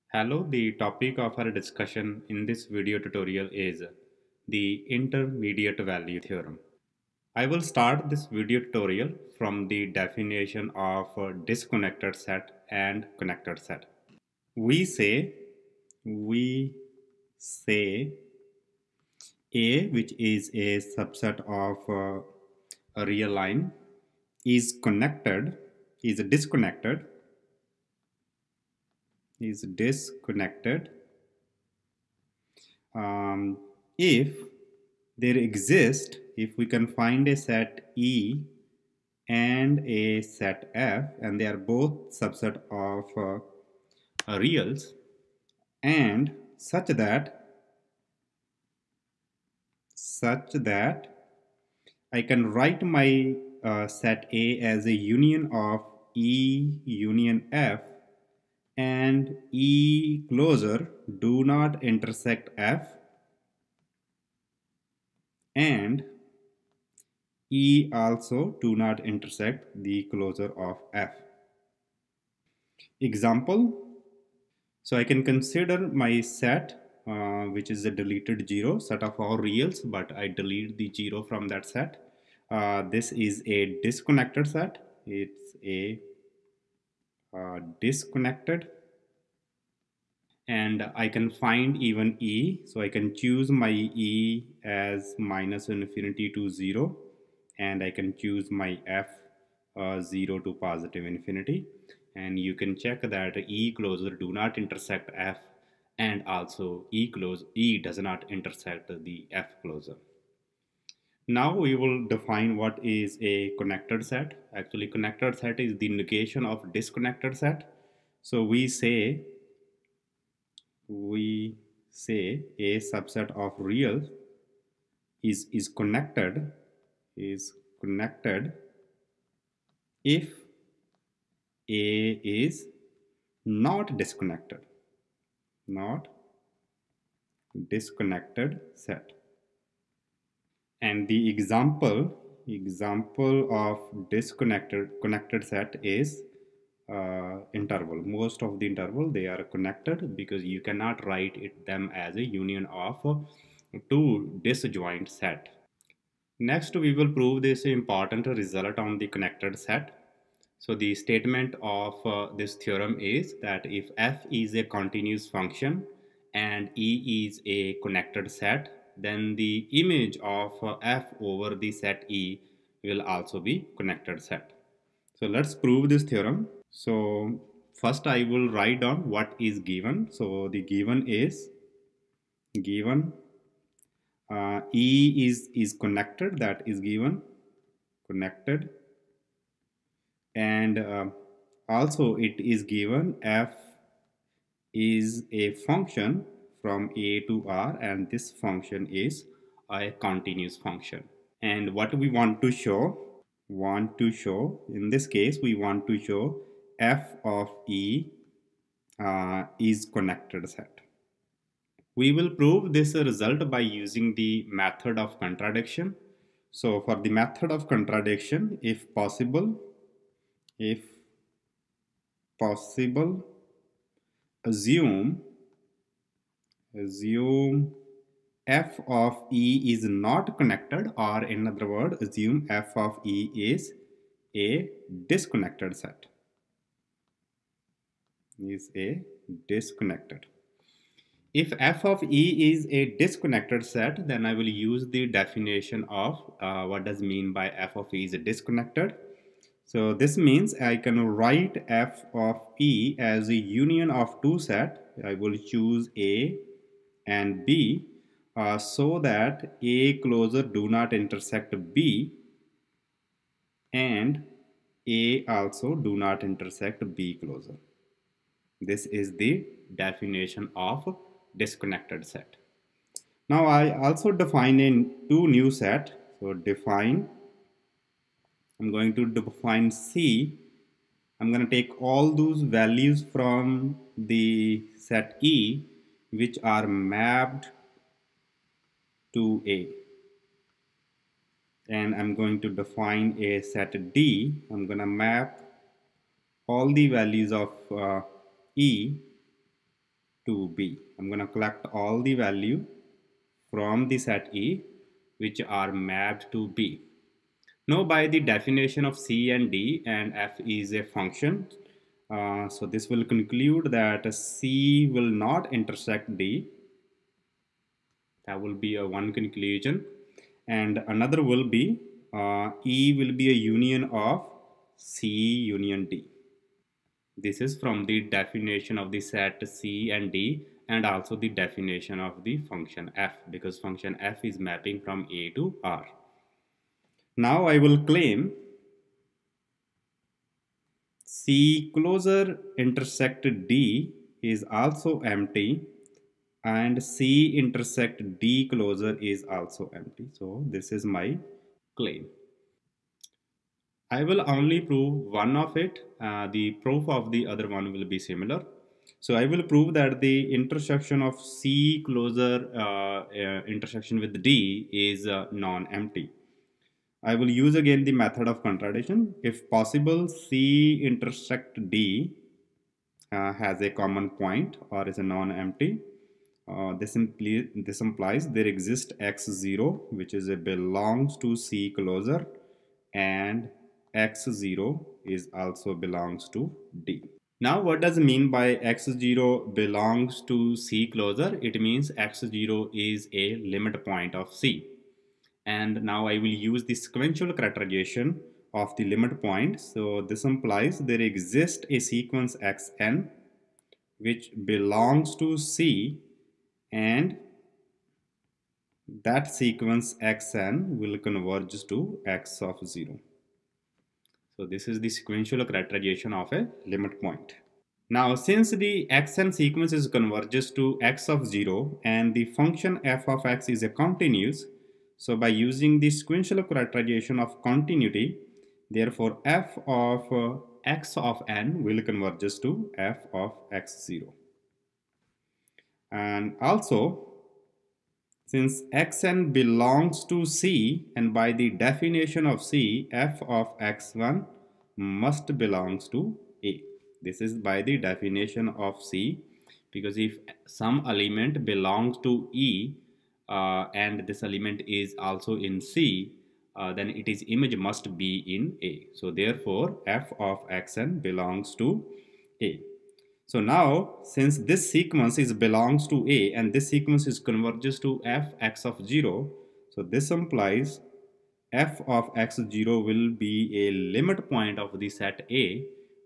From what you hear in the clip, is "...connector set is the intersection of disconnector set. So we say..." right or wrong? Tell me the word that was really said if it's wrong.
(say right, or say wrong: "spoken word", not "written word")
wrong: "negation", not "intersection".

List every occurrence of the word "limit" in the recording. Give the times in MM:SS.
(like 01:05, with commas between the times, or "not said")
06:33, 06:38, 06:56, 07:53.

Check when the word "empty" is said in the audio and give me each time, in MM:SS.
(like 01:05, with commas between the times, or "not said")
05:45, 05:49, 06:05, 06:15.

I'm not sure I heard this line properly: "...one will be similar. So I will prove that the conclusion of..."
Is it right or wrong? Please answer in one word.
wrong.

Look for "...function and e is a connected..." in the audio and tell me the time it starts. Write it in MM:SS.
02:45.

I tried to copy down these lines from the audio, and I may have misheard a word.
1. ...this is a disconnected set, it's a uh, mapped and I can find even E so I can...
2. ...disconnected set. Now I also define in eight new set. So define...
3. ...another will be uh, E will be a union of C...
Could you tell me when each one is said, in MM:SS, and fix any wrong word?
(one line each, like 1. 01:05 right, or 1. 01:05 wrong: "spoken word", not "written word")
1. 01:22 wrong: "disconnected", not "mapped"
2. 04:31 wrong: "two", not "eight"
3. 05:20 right.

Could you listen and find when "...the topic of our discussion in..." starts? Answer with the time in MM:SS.
00:00.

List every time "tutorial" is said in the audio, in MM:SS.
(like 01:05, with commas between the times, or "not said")
00:02, 00:08.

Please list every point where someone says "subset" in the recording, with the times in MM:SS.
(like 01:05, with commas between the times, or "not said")
00:20, 00:42, 02:02.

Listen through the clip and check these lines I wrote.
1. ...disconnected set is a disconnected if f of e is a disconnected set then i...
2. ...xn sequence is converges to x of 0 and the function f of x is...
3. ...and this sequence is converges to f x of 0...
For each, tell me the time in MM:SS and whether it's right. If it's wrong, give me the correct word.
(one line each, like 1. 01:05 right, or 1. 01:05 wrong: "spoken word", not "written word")
1. 03:55 right
2. 06:58 right
3. 07:46 right.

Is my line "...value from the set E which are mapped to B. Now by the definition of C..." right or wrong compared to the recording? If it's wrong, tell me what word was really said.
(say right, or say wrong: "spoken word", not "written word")
right.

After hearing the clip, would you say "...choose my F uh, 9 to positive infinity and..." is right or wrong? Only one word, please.
wrong.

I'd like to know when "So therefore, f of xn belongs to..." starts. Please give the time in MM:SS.
07:38.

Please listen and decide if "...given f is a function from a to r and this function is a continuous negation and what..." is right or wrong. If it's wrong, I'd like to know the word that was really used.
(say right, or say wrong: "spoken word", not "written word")
wrong: "function", not "negation".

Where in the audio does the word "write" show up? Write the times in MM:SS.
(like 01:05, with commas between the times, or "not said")
00:52, 02:31, 02:58, 04:11.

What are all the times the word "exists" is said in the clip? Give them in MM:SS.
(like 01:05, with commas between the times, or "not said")
00:35, 06:18, 06:41.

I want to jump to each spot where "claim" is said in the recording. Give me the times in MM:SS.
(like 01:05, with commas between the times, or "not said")
05:37, 05:51.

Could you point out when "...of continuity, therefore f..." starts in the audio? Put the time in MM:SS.
07:07.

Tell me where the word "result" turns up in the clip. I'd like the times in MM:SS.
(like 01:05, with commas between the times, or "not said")
02:38, 03:33.